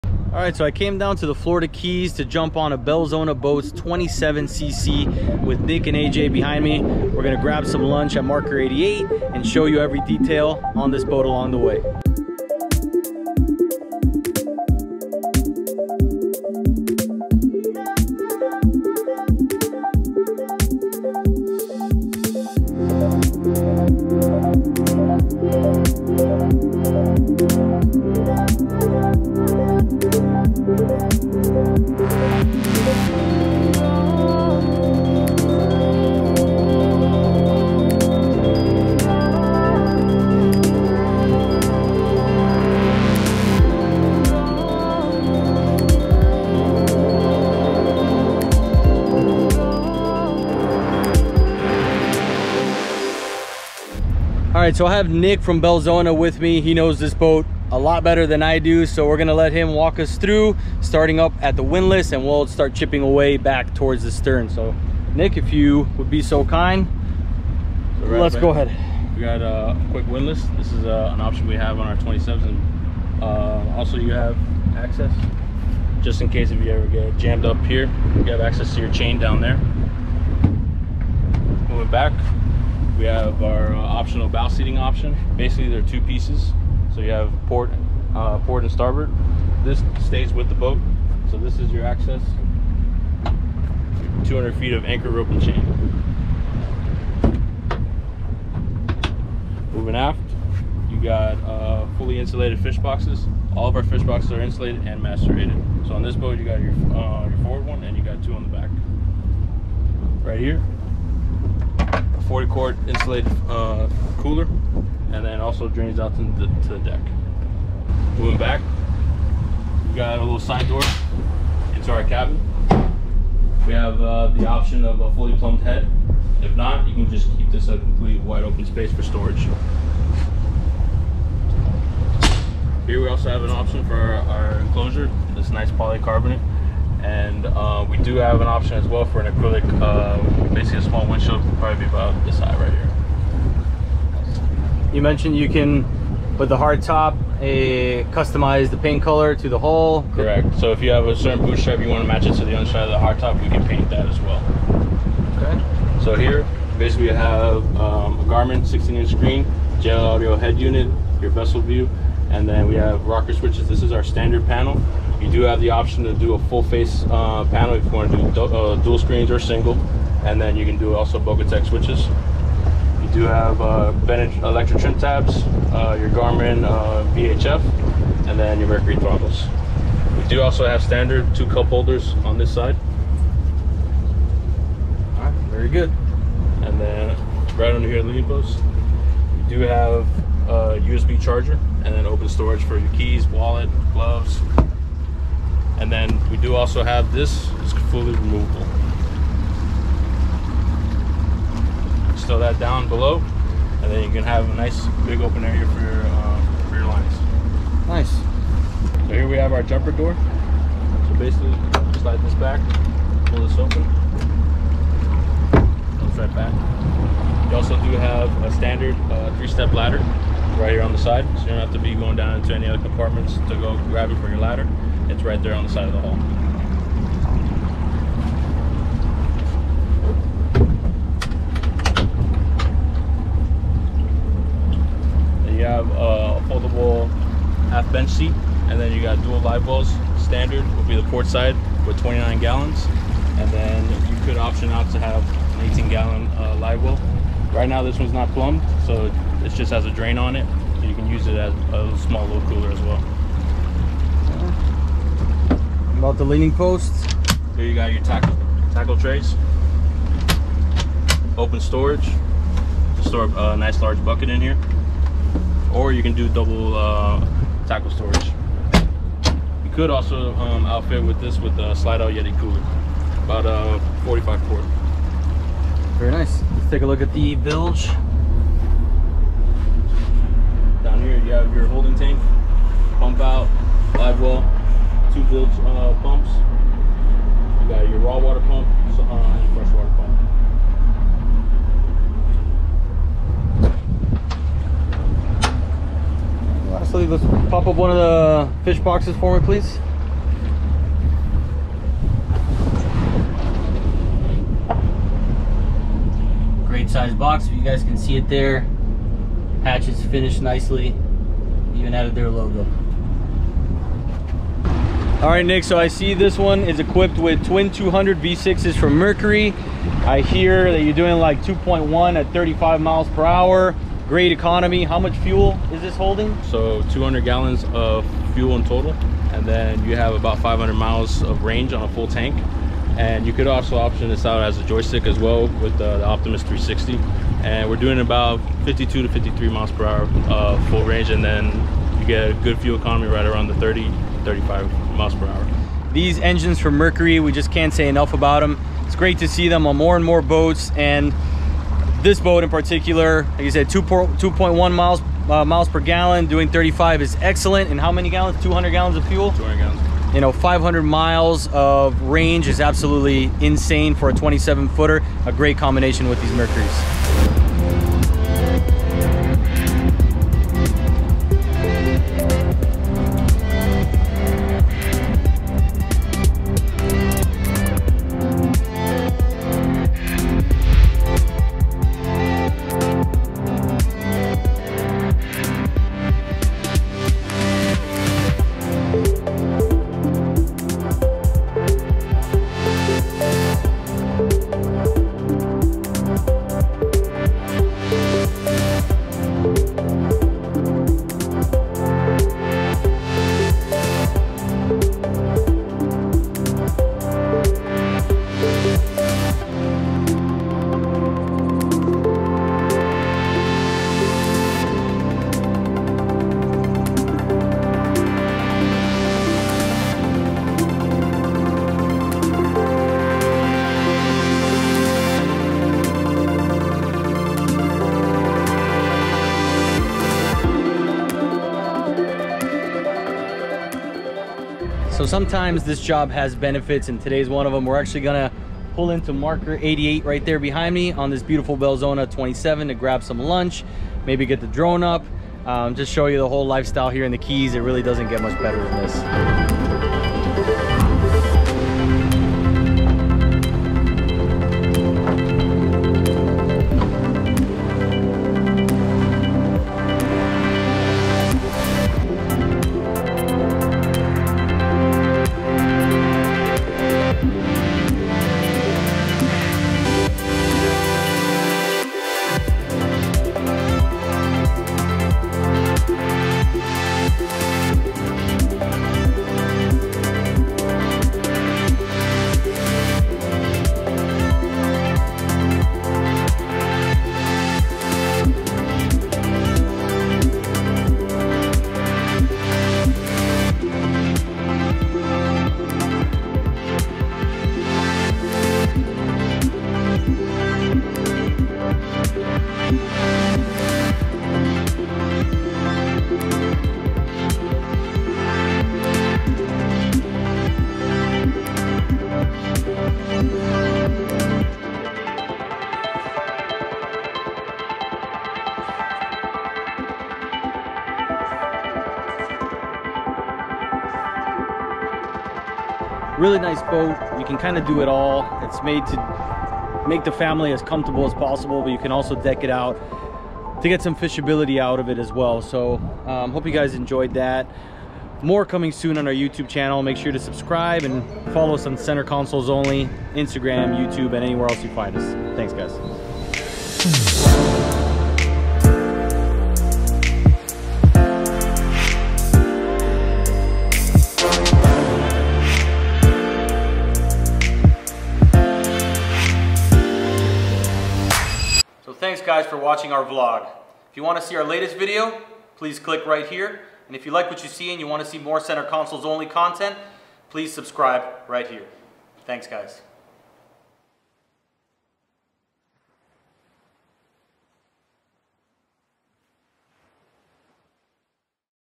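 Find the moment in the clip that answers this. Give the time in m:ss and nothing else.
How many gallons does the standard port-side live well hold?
4:01.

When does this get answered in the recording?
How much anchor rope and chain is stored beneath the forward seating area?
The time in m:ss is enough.
1:34.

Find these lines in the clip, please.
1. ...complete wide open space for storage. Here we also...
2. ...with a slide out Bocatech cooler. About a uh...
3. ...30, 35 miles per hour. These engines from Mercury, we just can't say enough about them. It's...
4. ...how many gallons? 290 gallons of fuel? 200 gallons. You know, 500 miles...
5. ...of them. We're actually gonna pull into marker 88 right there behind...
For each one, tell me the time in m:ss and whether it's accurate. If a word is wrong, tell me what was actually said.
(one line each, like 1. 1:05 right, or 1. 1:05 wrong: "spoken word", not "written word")
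1. 2:07 right
2. 4:31 wrong: "Yeti", not "Bocatech"
3. 5:43 right
4. 5:57 wrong: "200", not "290"
5. 7:17 right.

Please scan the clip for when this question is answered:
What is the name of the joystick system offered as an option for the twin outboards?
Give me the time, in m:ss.
5:36.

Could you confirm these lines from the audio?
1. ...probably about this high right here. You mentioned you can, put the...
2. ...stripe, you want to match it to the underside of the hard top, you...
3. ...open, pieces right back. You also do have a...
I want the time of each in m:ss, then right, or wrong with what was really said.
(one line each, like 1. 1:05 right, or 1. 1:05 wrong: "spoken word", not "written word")
1. 2:21 right
2. 2:31 right
3. 3:33 wrong: "comes", not "pieces".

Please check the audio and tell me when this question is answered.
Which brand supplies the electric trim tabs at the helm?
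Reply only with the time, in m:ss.
2:53.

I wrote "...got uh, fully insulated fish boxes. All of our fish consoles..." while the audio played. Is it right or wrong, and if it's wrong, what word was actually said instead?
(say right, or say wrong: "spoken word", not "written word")
wrong: "boxes", not "consoles".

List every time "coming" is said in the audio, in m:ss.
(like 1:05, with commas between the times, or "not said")
8:58.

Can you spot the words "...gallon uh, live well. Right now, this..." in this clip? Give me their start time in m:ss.
4:05.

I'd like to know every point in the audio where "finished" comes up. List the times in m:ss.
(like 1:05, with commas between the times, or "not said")
5:10.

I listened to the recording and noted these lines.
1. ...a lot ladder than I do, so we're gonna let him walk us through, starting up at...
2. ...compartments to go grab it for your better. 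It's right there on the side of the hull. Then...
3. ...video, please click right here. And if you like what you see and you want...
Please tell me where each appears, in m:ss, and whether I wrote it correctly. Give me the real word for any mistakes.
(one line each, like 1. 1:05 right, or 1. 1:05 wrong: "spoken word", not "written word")
1. 0:57 wrong: "better", not "ladder"
2. 3:42 wrong: "ladder", not "better"
3. 9:24 right.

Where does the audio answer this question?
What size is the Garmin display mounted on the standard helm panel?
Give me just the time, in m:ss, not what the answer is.
2:38.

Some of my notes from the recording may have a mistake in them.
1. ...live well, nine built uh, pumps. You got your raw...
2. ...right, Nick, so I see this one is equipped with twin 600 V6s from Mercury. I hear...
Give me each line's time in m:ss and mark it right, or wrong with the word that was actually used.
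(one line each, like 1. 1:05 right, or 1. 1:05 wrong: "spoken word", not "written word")
1. 4:43 wrong: "two", not "nine"
2. 5:15 wrong: "200", not "600".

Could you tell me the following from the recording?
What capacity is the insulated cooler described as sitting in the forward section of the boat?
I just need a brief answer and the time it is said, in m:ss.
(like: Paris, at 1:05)
40 quart, at 1:52.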